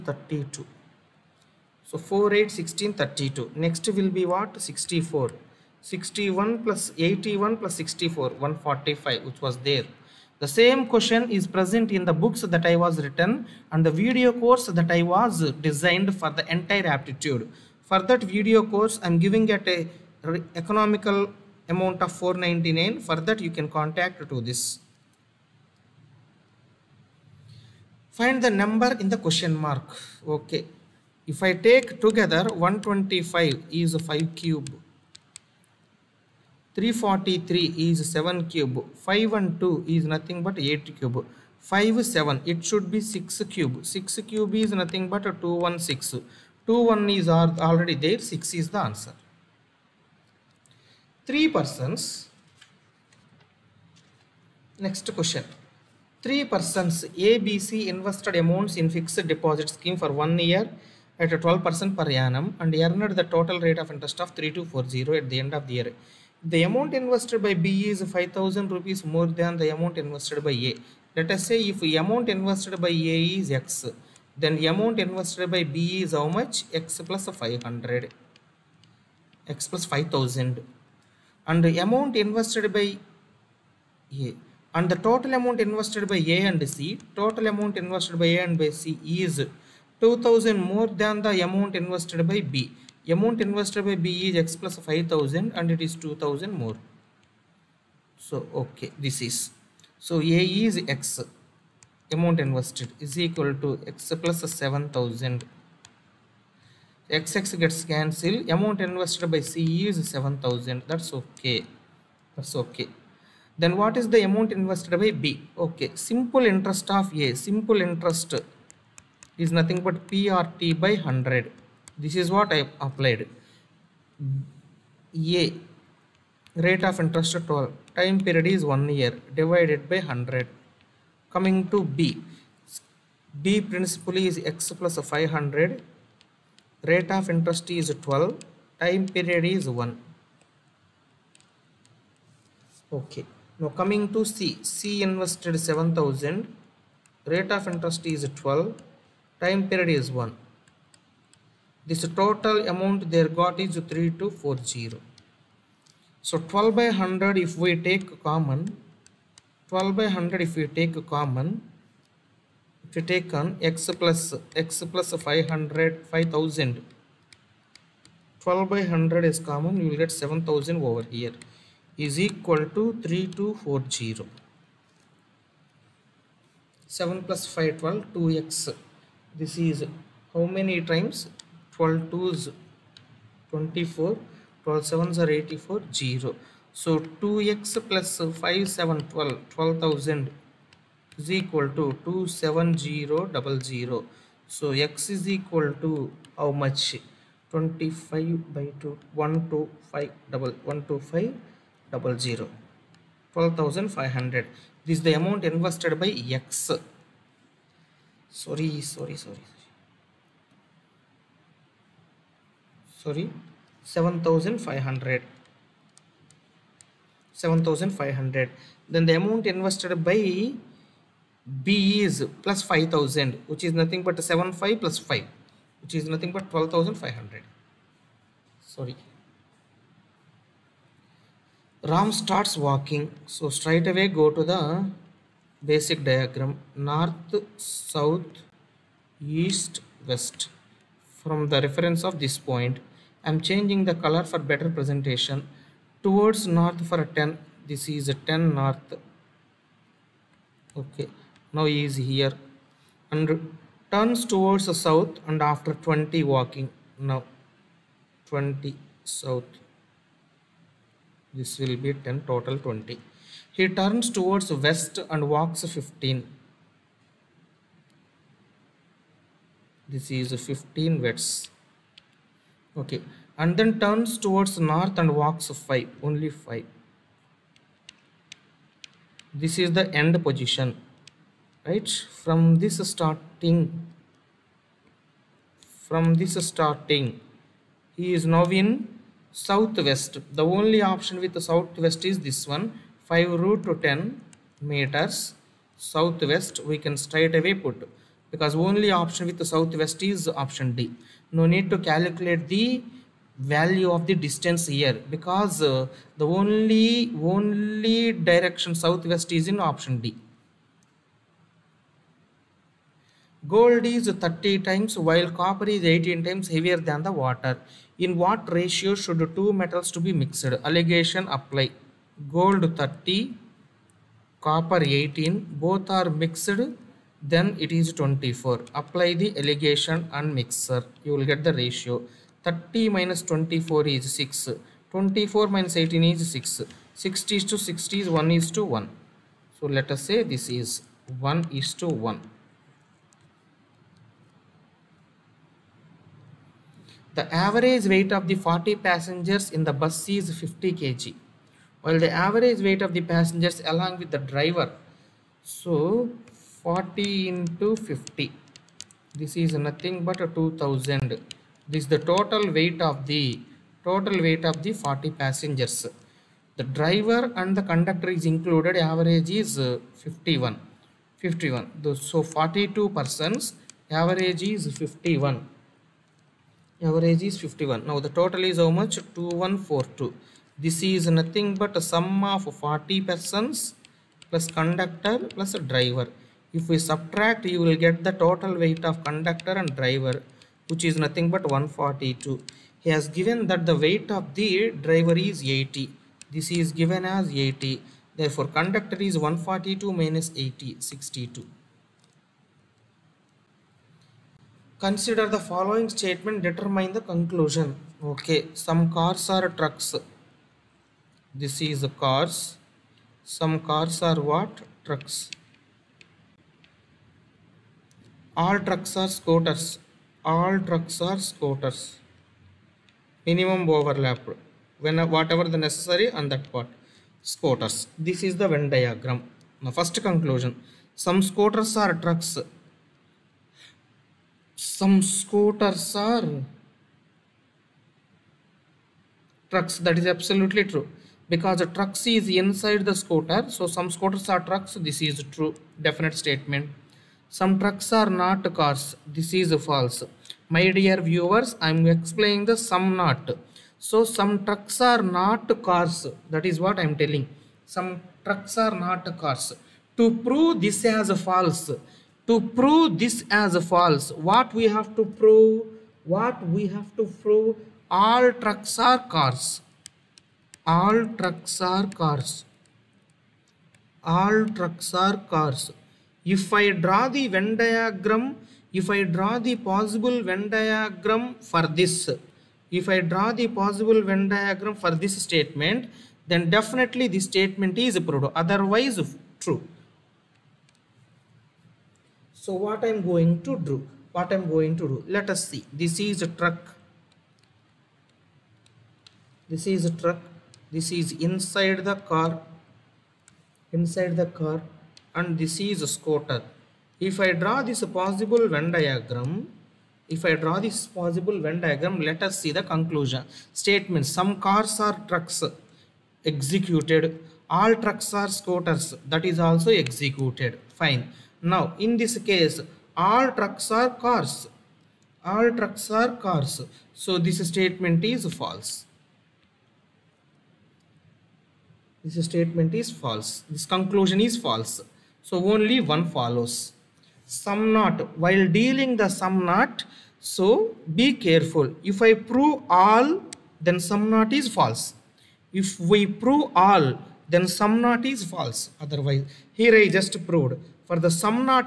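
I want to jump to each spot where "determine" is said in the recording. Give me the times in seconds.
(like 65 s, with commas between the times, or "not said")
406 s.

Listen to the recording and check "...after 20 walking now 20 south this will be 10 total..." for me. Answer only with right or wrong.
right.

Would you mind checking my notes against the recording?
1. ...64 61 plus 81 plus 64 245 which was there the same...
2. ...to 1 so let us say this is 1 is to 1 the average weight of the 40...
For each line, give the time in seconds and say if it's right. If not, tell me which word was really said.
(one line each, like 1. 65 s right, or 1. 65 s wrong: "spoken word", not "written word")
1. 4 s wrong: "145", not "245"
2. 338 s right.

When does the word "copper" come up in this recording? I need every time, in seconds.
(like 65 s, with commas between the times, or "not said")
315 s, 324 s.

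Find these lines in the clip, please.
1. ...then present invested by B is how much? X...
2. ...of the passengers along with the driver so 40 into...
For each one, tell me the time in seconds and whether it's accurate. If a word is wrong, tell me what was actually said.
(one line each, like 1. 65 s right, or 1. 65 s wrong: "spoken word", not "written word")
1. 74 s wrong: "amount", not "present"
2. 352 s right.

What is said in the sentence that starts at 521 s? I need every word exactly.
Now, in this case, all trucks are cars.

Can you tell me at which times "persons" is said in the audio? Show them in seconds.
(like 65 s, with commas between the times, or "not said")
51 s, 56 s, 372 s, 383 s.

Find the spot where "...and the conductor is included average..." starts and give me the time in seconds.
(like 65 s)
367 s.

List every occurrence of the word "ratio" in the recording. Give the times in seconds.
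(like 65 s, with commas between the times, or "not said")
318 s, 331 s.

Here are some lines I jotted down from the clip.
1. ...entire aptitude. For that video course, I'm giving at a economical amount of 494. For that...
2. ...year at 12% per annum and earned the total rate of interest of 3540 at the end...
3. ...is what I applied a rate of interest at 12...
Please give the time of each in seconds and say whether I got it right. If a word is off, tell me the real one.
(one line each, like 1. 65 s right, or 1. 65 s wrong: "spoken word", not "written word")
1. 16 s wrong: "499", not "494"
2. 60 s wrong: "3240", not "3540"
3. 122 s right.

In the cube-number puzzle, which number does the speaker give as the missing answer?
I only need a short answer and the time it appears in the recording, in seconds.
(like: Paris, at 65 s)
6, at 48 s.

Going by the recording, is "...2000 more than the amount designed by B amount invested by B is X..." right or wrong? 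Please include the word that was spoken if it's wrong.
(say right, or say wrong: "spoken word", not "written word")
wrong: "invested", not "designed".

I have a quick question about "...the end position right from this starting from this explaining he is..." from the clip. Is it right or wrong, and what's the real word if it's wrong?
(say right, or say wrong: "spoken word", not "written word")
wrong: "starting", not "explaining".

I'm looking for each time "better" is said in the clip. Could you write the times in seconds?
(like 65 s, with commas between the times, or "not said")
244 s.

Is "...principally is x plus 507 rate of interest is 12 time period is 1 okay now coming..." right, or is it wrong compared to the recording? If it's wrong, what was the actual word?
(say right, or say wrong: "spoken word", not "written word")
wrong: "500", not "507".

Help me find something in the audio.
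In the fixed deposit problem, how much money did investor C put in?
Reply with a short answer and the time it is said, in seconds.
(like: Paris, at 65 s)
7000, at 108 s.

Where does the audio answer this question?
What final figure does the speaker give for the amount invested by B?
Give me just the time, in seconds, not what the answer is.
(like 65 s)
226 s.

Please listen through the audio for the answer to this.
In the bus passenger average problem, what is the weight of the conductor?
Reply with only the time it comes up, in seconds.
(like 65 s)
400 s.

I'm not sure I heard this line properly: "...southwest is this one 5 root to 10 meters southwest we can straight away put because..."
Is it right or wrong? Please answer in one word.
right.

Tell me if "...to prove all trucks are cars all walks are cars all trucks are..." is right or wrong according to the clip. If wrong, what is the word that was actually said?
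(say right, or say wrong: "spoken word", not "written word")
wrong: "trucks", not "walks".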